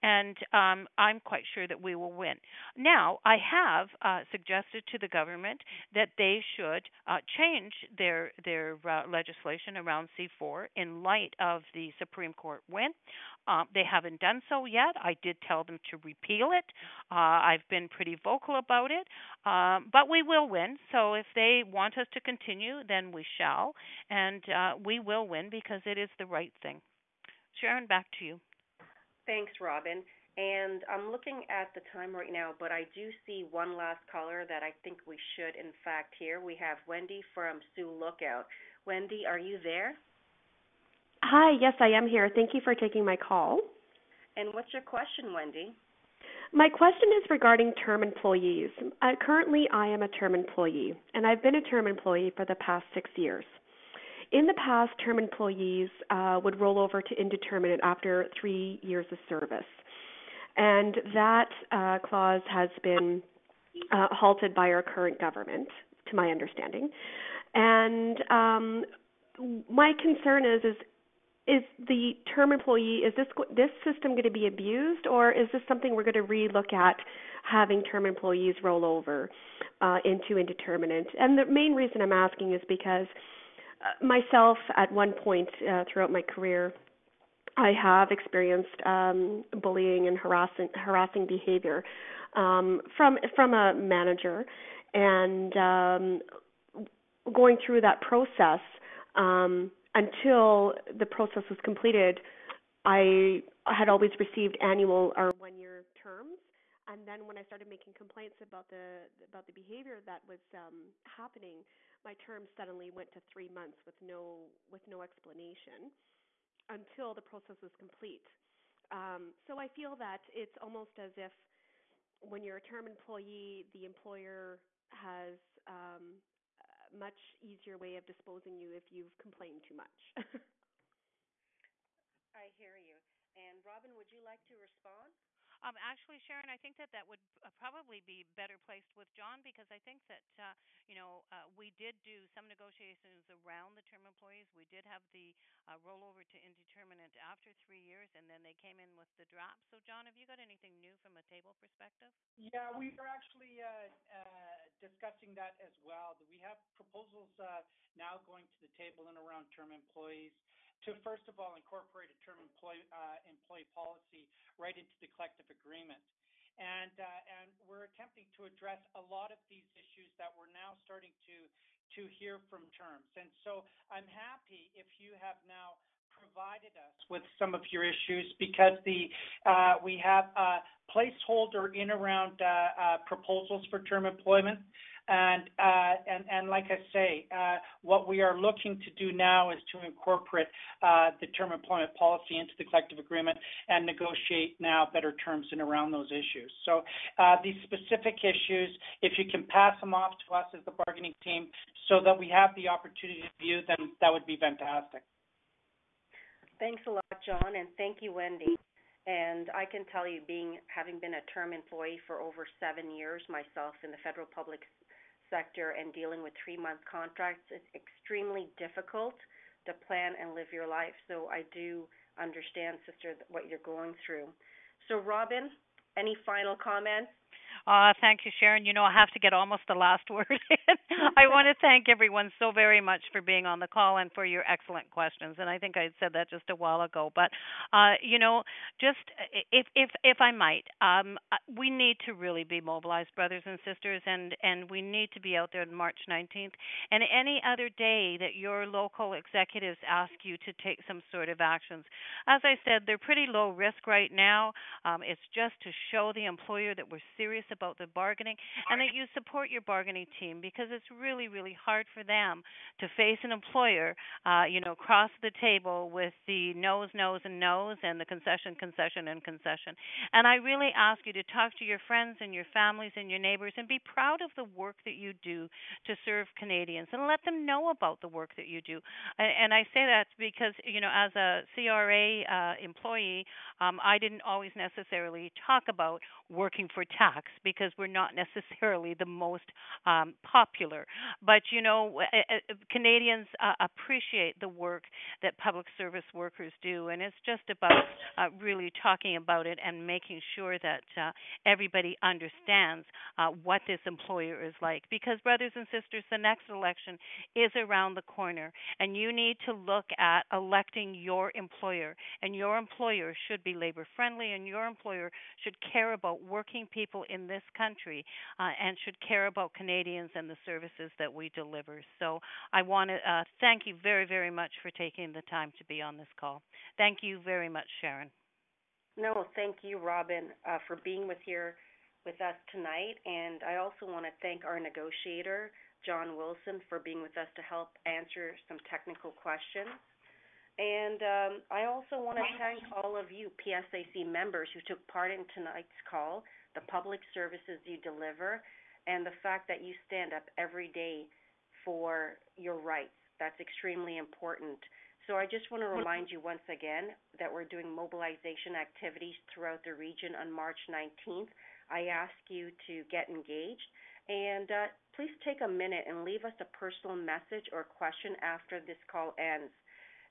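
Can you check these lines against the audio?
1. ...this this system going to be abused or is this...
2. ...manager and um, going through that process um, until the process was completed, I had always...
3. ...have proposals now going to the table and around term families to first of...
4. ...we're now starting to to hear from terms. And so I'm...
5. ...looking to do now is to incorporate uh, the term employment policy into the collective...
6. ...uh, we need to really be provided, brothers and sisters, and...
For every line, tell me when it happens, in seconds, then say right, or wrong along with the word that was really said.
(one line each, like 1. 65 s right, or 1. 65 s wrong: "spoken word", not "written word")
1. 73 s right
2. 93 s right
3. 156 s wrong: "employees", not "families"
4. 170 s right
5. 188 s right
6. 241 s wrong: "mobilized", not "provided".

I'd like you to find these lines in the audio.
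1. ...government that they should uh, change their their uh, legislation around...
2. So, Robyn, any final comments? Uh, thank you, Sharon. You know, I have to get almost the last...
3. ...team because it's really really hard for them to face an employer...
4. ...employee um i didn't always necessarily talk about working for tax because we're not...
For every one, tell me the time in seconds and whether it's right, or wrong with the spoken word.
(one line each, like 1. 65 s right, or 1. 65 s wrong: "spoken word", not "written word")
1. 5 s right
2. 224 s right
3. 260 s right
4. 282 s right.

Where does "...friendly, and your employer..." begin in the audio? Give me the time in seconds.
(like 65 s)
313 s.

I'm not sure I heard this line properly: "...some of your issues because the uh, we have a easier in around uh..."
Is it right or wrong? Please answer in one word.
wrong.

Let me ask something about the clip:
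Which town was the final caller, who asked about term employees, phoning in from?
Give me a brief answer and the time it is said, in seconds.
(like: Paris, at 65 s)
Sioux Lookout, at 37 s.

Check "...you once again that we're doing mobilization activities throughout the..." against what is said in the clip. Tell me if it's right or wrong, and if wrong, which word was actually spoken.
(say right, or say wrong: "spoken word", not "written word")
right.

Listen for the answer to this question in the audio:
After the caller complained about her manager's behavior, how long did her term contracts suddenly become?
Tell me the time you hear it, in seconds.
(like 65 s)
113 s.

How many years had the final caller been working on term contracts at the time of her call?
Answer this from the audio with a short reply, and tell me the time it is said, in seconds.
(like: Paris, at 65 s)
6, at 52 s.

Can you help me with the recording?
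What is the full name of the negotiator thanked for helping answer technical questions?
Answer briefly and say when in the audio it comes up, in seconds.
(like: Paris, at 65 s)
John Wilson, at 335 s.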